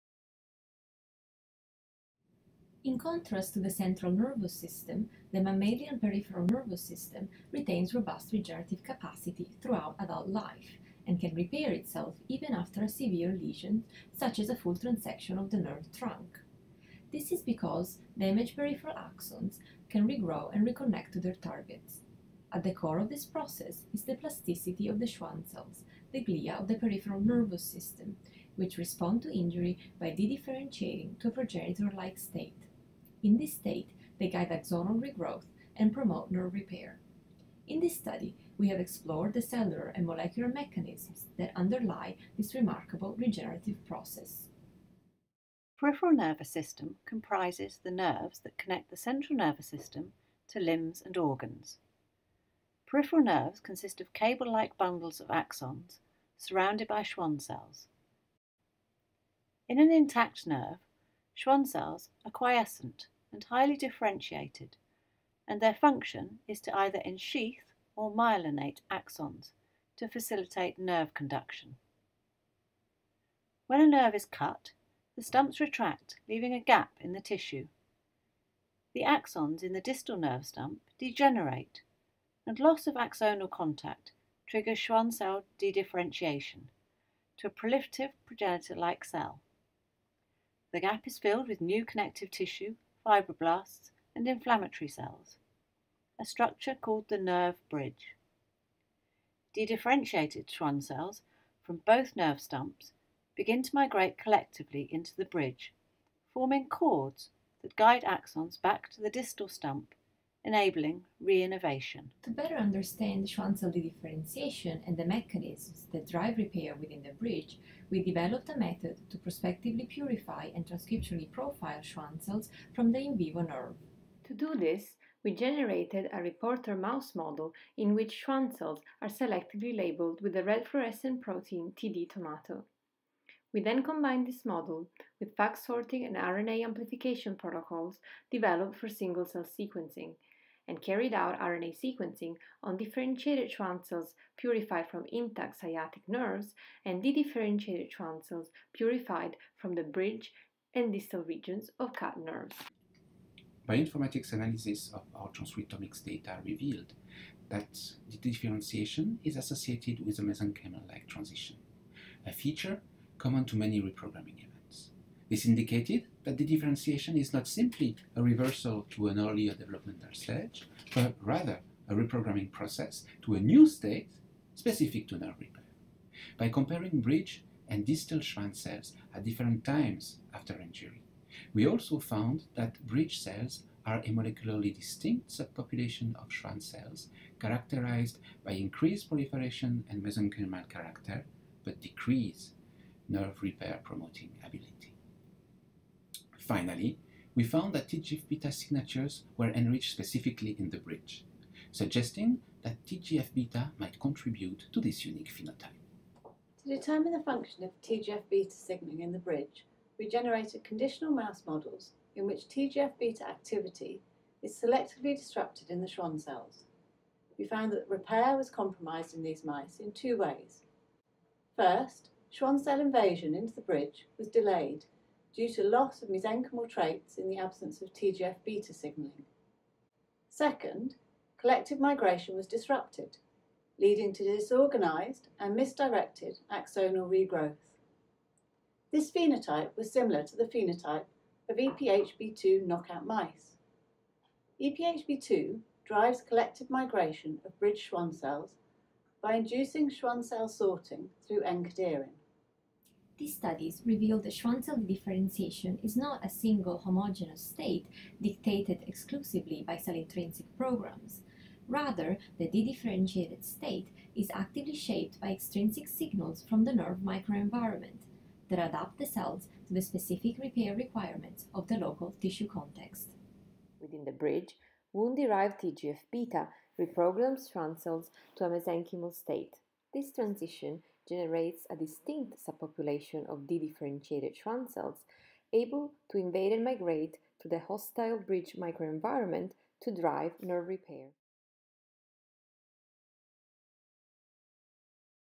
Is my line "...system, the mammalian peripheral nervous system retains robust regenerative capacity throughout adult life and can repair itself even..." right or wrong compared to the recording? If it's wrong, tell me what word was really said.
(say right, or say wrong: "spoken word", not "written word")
right.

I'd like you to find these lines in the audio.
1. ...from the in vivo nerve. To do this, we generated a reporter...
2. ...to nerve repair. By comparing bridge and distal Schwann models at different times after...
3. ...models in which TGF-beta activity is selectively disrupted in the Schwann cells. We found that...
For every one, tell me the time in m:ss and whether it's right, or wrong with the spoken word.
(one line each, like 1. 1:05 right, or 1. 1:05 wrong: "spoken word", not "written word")
1. 2:02 right
2. 2:55 wrong: "cells", not "models"
3. 3:31 right.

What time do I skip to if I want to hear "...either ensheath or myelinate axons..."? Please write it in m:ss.
1:06.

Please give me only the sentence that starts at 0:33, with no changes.
In this state, they guide axonal regrowth and promote nerve repair.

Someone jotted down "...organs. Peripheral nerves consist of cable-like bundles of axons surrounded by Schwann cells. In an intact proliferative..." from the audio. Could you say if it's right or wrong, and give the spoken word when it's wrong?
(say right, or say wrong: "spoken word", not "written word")
wrong: "nerve", not "proliferative".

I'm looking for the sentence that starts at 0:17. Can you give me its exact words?
This is because damaged peripheral axons can regrow and reconnect to their targets.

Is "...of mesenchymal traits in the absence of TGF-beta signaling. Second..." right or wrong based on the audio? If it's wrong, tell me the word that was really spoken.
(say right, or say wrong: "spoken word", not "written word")
right.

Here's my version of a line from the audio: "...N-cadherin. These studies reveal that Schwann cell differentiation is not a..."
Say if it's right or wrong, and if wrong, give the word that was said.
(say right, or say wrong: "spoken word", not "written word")
right.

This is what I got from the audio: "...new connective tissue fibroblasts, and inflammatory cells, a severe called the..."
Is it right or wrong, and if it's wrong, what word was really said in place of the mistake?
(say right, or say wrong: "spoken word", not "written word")
wrong: "structure", not "severe".